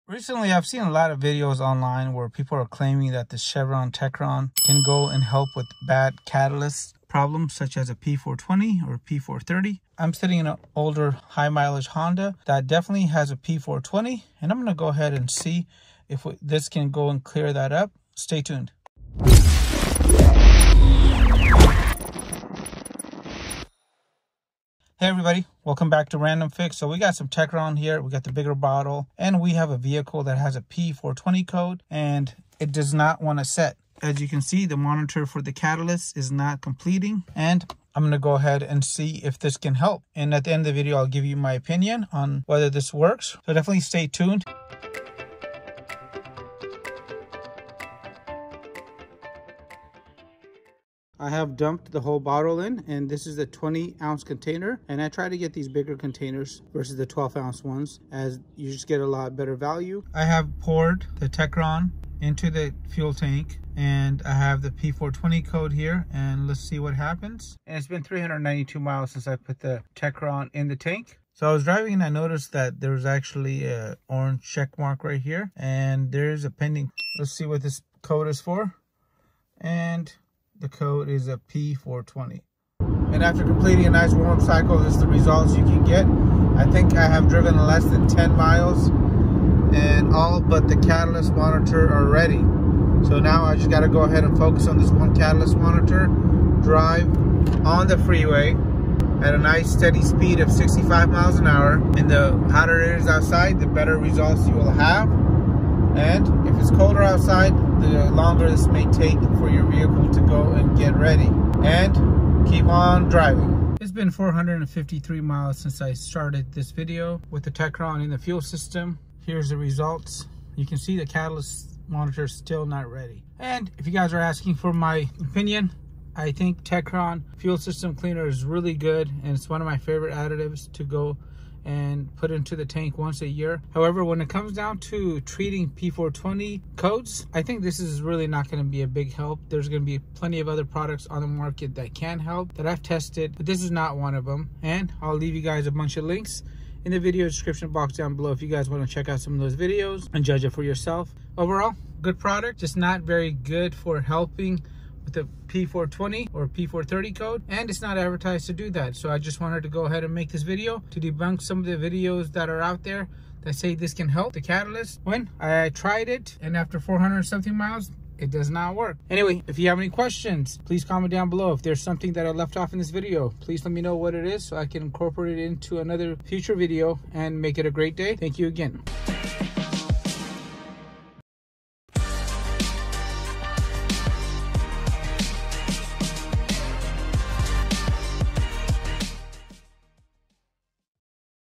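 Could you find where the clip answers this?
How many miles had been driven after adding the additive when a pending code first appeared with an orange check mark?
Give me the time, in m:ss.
1:08.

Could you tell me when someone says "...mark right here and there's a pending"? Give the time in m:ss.
1:14.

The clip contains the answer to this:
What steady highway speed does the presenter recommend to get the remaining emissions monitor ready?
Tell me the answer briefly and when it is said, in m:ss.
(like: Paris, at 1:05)
65 miles an hour, at 1:40.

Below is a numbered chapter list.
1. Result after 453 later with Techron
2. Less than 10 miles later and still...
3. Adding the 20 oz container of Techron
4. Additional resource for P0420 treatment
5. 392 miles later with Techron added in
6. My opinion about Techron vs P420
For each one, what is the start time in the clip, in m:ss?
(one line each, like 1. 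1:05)
1. 1:53
2. 1:22
3. 0:44
4. 2:22
5. 1:07
6. 2:03.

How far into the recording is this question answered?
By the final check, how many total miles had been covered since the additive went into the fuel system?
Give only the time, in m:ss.
1:54.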